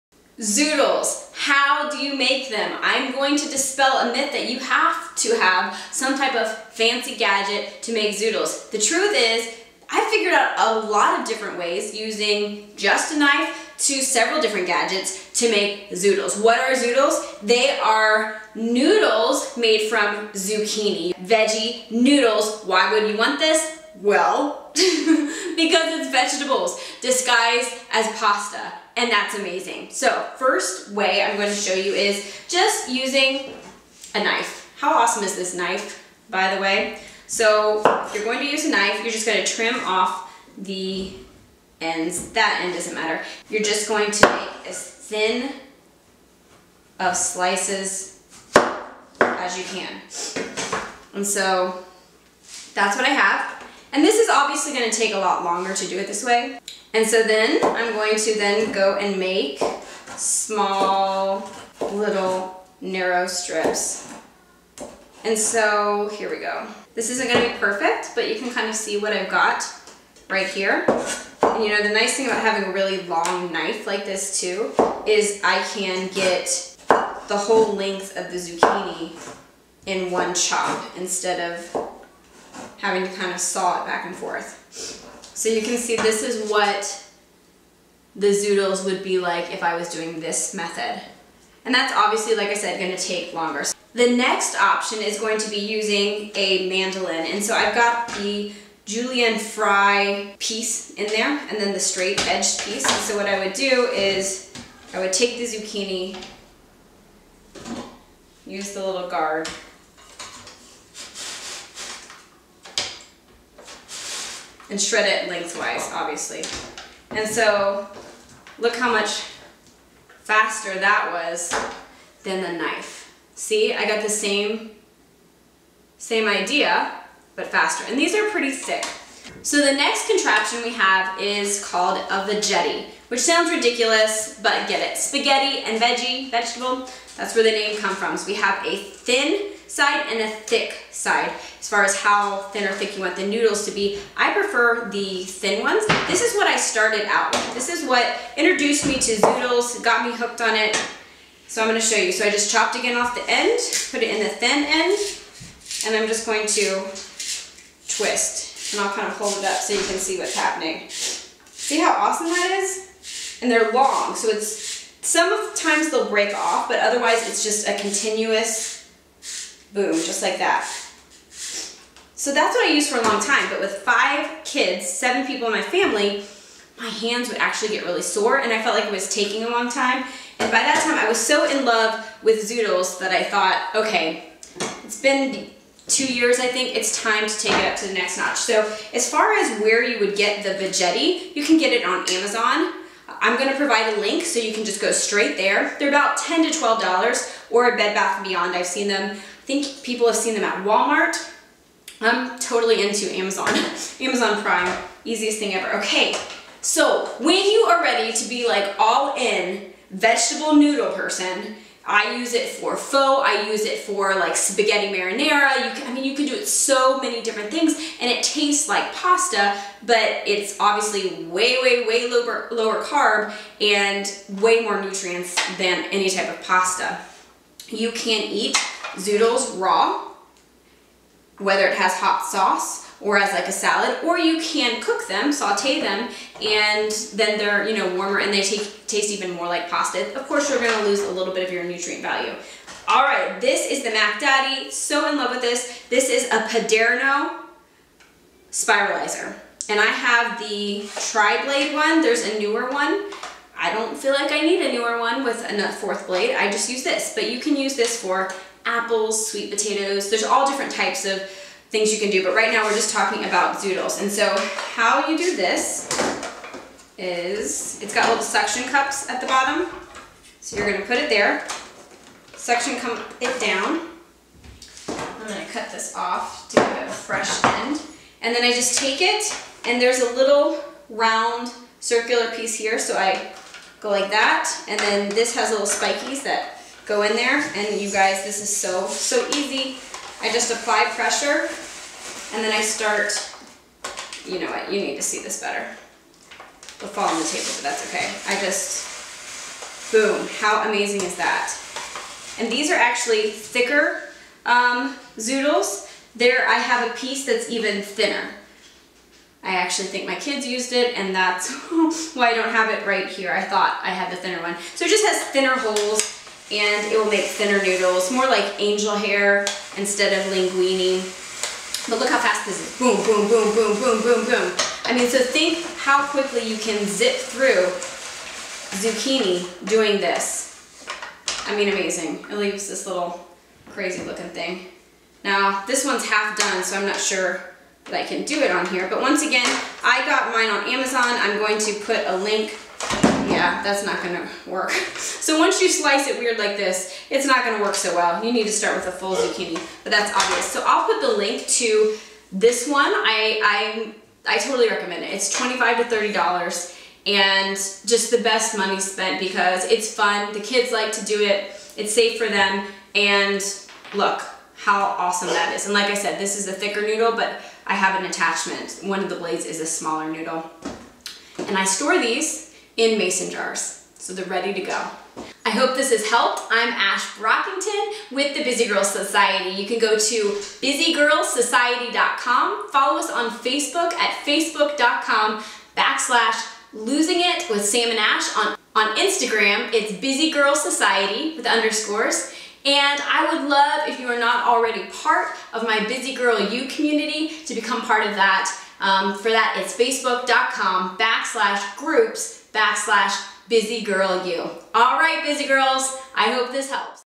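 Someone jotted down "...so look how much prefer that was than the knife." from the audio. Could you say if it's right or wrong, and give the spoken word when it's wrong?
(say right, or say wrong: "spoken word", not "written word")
wrong: "faster", not "prefer".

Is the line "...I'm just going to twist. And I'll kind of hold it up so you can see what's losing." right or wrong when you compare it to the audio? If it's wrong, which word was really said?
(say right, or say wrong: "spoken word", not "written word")
wrong: "happening", not "losing".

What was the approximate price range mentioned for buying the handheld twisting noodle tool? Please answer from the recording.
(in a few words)
$10 to $12.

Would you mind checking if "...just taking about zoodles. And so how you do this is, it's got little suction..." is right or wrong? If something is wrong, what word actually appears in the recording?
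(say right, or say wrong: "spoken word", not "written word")
wrong: "talking", not "taking".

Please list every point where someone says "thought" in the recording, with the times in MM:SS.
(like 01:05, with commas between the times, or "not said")
03:03, 05:13.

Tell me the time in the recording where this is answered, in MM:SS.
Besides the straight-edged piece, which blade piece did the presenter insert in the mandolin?
01:38.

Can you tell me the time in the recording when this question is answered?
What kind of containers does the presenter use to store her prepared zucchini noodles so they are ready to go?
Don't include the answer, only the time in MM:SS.
06:12.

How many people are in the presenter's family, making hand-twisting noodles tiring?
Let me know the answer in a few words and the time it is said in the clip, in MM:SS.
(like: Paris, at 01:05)
7, at 02:54.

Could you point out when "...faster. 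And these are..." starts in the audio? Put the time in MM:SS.
02:07.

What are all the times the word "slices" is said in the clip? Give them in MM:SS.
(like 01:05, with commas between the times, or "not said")
00:47, 05:45.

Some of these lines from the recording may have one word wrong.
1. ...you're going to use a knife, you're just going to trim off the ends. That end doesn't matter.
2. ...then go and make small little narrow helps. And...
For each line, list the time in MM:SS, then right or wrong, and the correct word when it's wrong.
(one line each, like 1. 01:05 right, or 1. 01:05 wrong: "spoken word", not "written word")
1. 00:38 right
2. 00:58 wrong: "strips", not "helps".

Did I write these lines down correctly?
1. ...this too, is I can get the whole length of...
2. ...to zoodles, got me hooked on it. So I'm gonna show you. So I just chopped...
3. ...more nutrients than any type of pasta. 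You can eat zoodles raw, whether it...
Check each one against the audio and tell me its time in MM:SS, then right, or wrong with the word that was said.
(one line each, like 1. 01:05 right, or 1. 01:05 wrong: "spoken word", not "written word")
1. 01:14 right
2. 02:28 right
3. 03:44 right.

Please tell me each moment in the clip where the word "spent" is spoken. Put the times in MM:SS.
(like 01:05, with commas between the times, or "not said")
05:58.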